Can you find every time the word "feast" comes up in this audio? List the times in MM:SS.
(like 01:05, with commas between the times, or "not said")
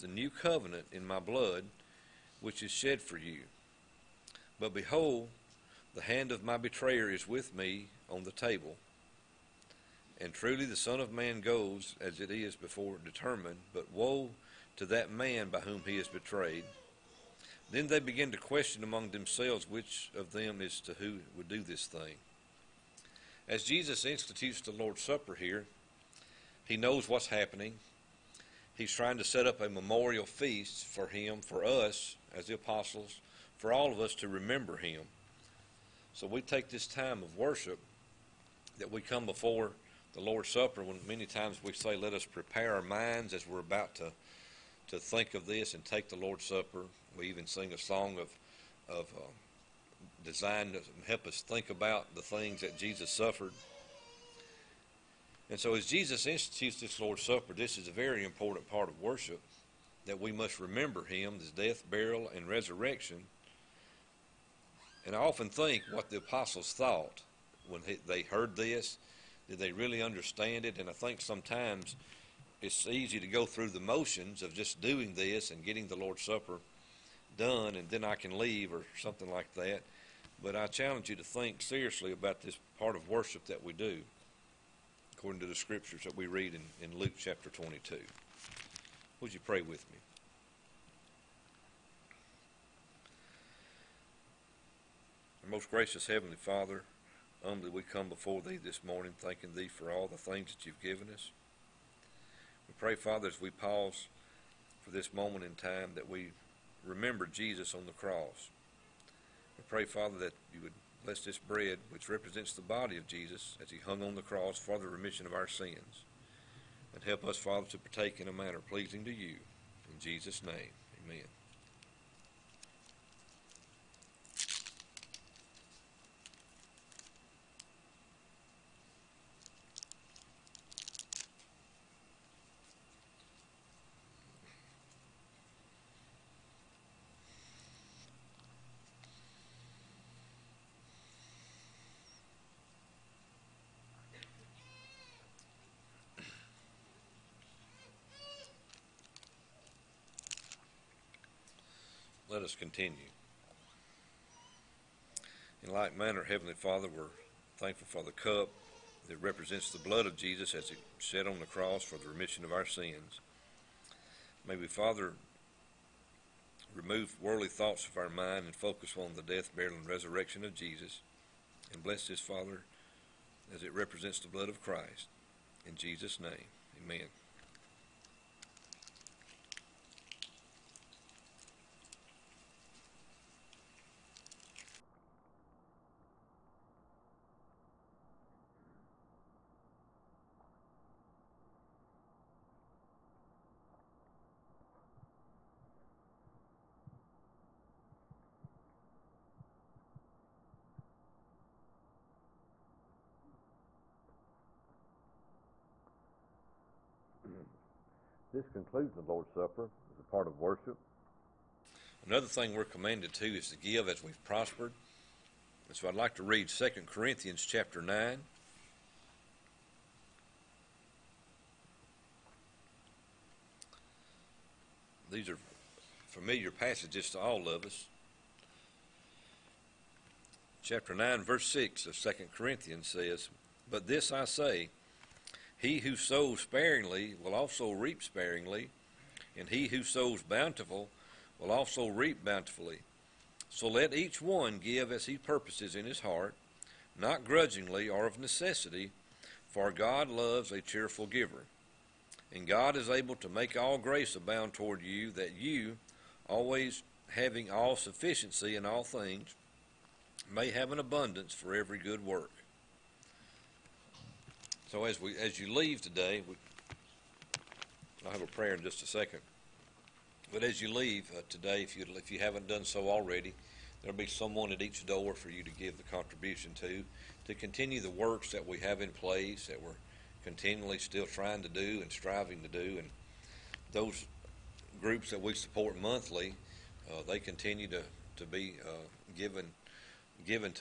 00:30.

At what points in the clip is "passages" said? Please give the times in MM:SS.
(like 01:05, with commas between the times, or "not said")
03:46.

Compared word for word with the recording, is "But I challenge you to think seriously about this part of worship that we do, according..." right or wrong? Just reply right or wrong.
right.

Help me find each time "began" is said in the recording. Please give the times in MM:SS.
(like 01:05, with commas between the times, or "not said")
00:17.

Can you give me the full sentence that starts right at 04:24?
So as we as you leave today, we, I'll have a prayer in just a second.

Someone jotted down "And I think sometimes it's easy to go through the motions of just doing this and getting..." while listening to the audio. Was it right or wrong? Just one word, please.
right.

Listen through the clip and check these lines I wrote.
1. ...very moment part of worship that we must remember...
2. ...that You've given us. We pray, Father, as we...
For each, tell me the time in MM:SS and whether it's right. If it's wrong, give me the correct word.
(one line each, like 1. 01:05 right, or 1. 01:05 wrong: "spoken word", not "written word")
1. 00:57 wrong: "important", not "moment"
2. 01:40 right.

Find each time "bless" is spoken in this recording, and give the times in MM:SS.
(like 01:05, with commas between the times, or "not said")
01:51, 02:51.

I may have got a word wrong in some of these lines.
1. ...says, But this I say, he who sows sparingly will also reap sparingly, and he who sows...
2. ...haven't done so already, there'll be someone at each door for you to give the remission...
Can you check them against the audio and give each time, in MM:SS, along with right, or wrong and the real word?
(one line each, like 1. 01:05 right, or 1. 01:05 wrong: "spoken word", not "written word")
1. 03:52 right
2. 04:32 wrong: "contribution", not "remission".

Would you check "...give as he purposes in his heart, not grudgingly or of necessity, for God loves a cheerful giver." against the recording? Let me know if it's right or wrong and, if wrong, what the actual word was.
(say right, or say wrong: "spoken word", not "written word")
right.